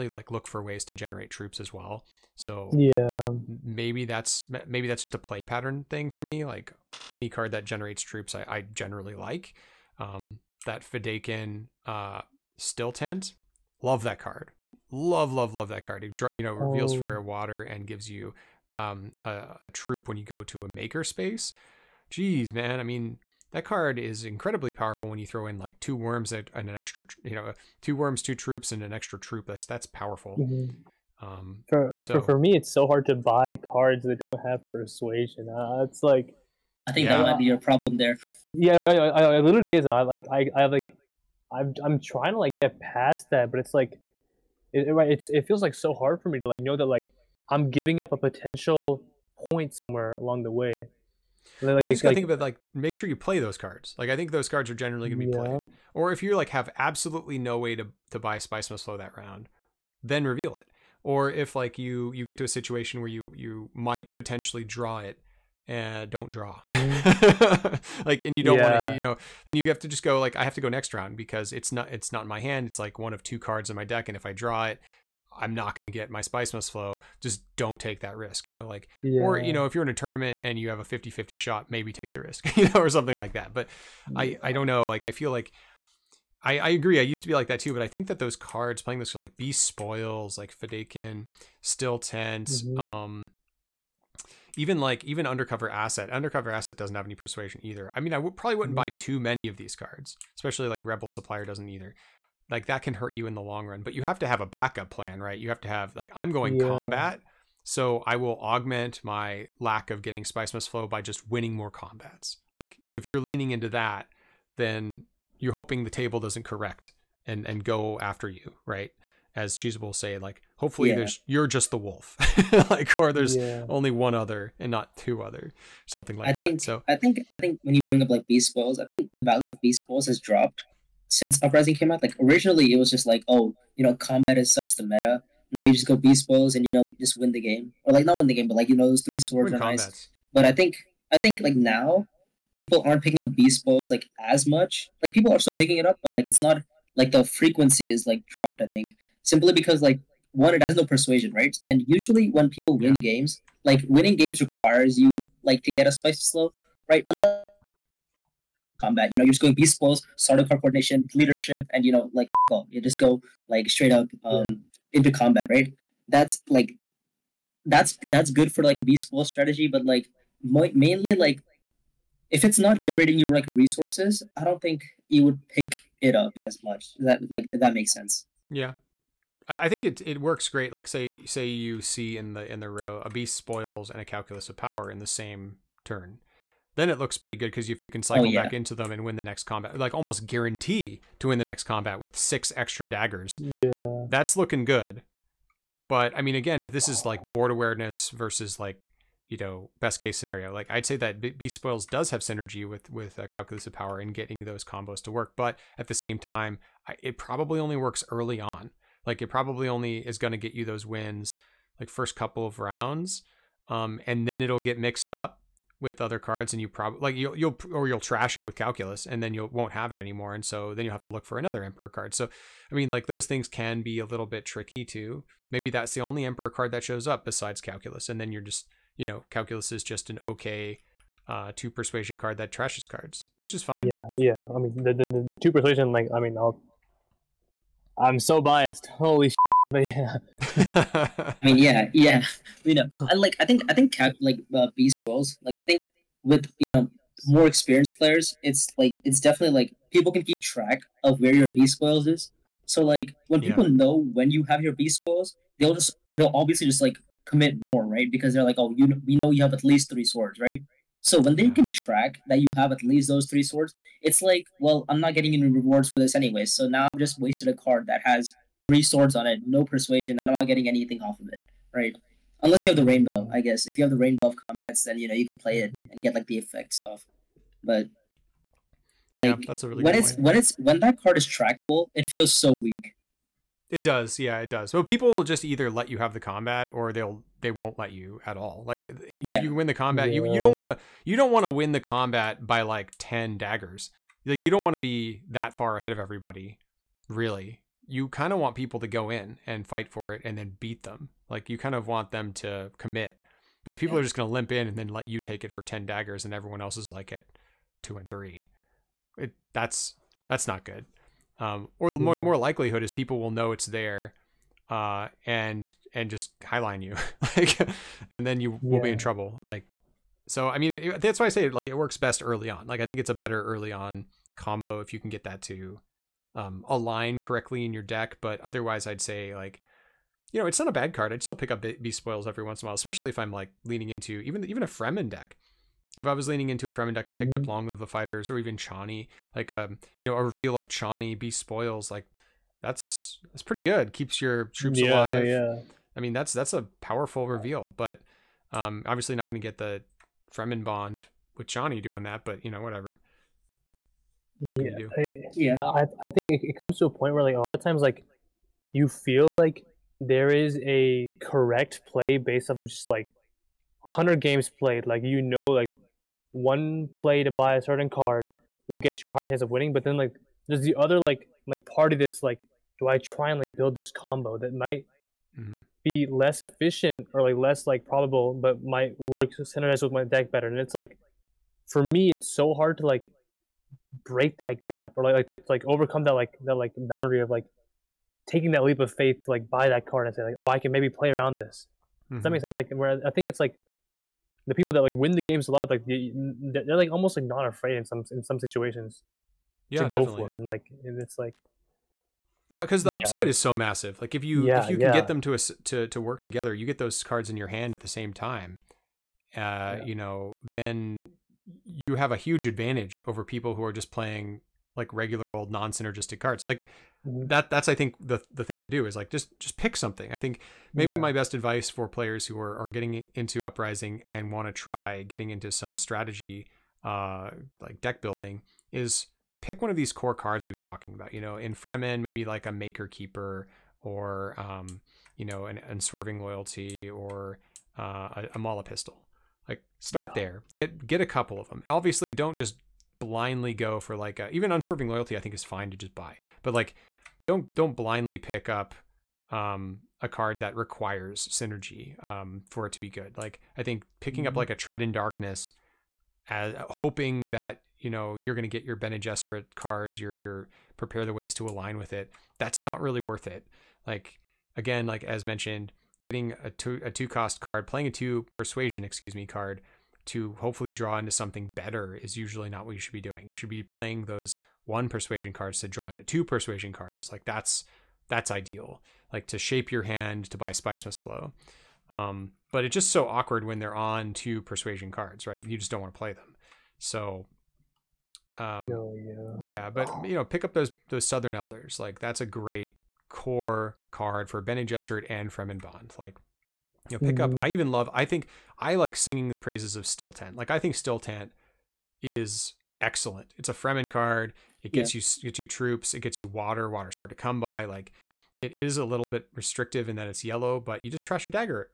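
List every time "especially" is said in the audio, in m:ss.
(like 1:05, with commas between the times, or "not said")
1:40, 5:32.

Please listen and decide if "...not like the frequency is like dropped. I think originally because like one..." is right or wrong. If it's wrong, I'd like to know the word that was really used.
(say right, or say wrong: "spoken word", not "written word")
wrong: "simply", not "originally".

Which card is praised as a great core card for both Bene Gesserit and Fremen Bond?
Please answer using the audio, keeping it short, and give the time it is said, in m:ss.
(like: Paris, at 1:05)
Southern Elders, at 8:11.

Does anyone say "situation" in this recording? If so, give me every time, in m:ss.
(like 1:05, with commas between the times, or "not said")
1:02, 6:38.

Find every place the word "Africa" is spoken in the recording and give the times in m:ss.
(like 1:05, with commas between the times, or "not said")
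not said.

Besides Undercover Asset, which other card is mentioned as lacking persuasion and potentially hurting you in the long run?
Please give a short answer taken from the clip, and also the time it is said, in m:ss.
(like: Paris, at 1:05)
Rebel Supplier, at 1:40.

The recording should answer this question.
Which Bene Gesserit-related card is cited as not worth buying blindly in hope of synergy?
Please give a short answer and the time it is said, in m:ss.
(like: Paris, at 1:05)
Tread in Darkness, at 7:34.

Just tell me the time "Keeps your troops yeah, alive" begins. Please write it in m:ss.
5:43.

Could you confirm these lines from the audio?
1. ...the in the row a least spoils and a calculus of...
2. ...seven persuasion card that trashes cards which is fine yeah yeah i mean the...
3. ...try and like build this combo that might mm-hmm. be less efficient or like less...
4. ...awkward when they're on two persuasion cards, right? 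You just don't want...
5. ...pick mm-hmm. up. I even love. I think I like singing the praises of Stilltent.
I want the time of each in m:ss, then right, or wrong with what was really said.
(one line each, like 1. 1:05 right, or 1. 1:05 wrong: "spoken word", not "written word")
1. 3:02 wrong: "beast", not "least"
2. 3:51 wrong: "two", not "seven"
3. 6:12 right
4. 8:03 right
5. 8:17 right.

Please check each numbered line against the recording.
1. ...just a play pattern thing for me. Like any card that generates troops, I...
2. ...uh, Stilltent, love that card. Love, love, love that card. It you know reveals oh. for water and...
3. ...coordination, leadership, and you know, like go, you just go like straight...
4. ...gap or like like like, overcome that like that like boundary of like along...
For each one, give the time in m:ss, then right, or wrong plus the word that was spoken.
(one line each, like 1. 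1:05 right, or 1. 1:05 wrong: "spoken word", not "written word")
1. 0:05 right
2. 0:11 right
3. 2:40 right
4. 6:24 wrong: "taking", not "along".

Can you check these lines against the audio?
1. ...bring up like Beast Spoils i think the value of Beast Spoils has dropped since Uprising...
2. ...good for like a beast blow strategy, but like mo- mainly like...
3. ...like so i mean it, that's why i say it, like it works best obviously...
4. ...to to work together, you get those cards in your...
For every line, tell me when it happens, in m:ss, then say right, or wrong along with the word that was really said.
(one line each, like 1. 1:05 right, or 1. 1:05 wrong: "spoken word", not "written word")
1. 2:07 right
2. 2:48 right
3. 5:19 wrong: "early", not "obviously"
4. 6:45 right.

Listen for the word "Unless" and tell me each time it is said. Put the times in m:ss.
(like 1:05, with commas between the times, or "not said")
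2:37, 4:32.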